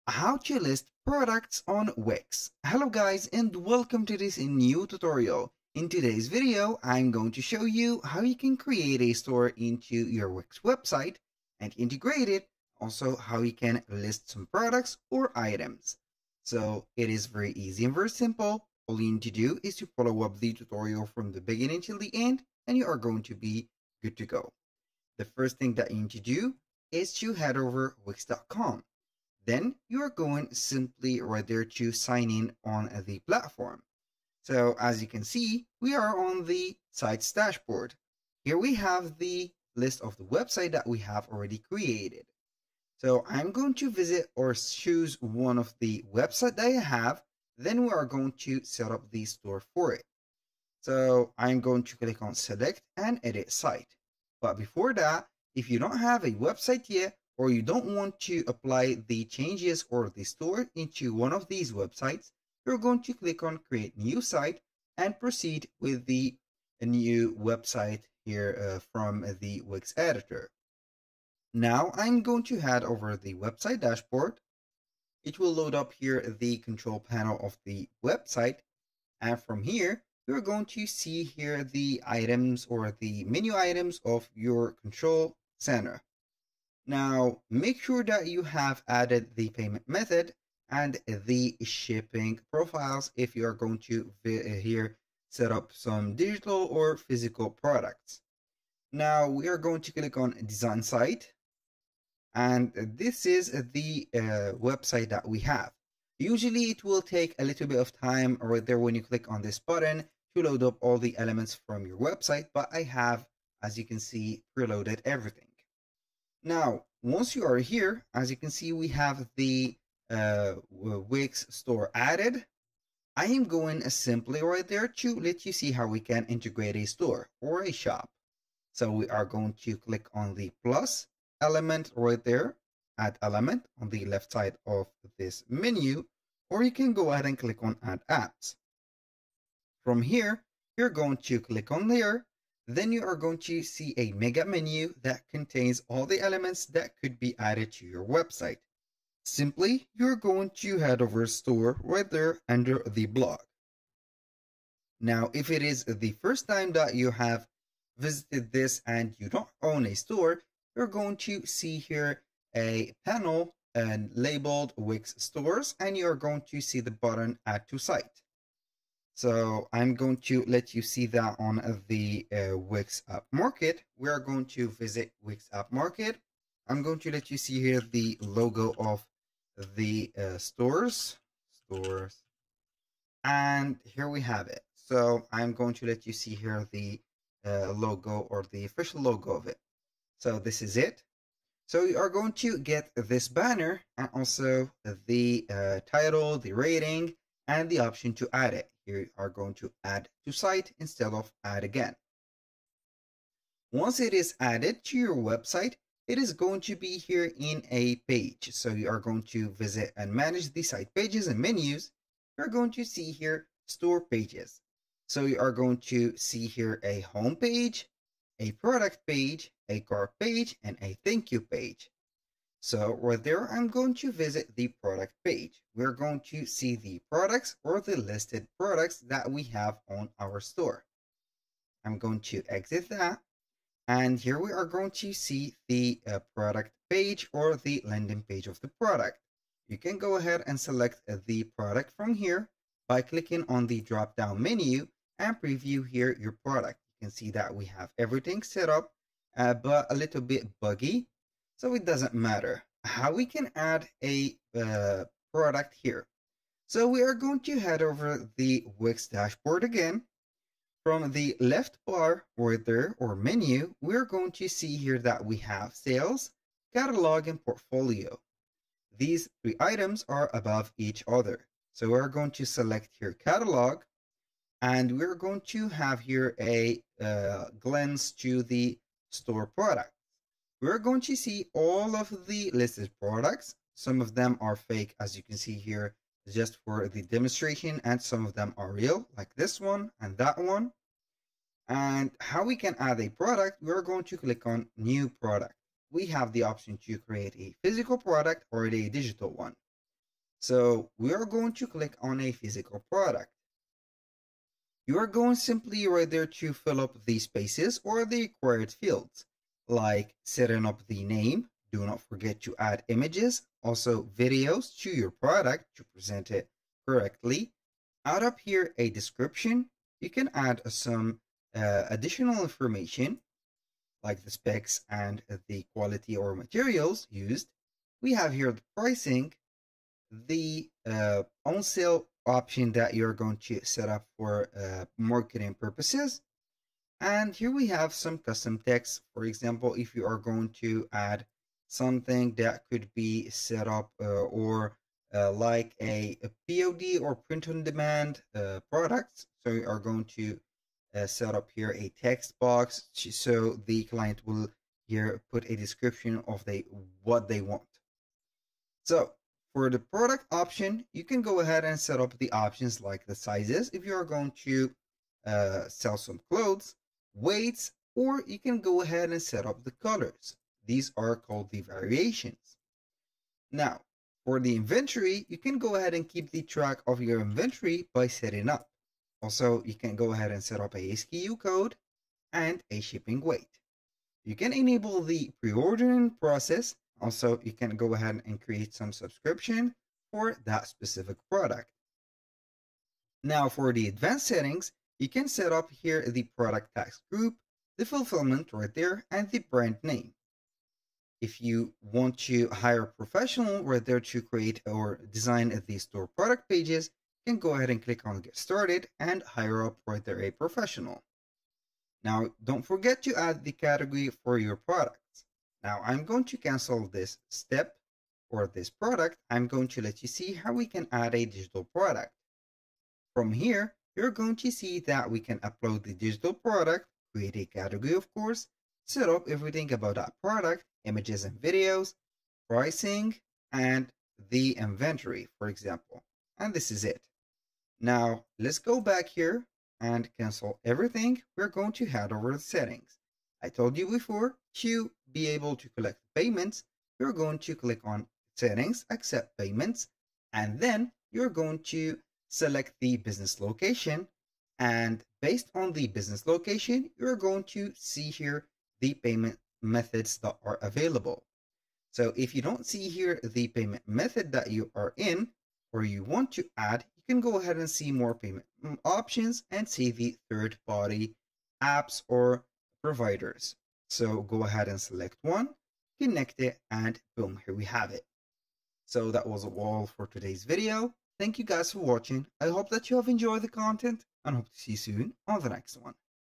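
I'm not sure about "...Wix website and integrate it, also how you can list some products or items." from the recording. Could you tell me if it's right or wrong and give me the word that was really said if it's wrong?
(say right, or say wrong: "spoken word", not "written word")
right.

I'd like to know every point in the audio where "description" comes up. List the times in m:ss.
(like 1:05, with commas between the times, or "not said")
5:18, 5:55.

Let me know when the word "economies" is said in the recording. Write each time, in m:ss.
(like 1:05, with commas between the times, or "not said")
not said.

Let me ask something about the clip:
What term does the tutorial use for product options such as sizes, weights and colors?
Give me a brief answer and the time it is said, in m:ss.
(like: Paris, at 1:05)
variations, at 6:11.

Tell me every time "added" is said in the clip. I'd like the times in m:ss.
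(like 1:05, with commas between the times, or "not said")
1:28, 2:01, 2:27, 3:24.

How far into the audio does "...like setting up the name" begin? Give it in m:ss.
5:09.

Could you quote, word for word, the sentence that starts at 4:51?
And how we can add a product, we're going to click on New Product.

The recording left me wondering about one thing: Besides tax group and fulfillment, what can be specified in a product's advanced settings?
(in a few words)
brand name.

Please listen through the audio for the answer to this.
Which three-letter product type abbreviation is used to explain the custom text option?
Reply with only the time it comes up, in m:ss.
5:46.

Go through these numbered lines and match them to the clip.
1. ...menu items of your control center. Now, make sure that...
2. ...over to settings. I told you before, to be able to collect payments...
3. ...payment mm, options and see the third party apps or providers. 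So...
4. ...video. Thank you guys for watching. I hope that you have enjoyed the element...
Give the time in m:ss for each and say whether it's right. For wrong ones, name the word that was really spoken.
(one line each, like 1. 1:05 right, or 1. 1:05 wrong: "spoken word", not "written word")
1. 1:23 right
2. 7:22 right
3. 7:48 right
4. 8:00 wrong: "content", not "element".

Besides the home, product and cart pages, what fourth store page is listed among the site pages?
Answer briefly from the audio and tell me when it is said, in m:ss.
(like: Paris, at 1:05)
thank you page, at 3:40.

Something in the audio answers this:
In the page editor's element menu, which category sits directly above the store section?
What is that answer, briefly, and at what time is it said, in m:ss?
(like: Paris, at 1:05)
blog, at 2:32.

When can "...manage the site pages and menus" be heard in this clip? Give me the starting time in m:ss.
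3:30.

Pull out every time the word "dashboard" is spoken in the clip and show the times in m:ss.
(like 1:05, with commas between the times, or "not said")
0:37, 1:13, 4:19.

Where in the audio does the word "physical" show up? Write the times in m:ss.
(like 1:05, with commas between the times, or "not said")
1:36, 4:57, 5:02.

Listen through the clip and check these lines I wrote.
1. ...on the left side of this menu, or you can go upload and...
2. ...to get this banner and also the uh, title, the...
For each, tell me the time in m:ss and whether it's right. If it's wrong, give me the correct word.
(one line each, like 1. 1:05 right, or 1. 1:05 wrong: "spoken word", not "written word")
1. 2:13 wrong: "ahead", not "upload"
2. 3:12 right.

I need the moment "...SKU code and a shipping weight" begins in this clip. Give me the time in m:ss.
6:20.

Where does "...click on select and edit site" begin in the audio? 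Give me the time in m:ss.
0:51.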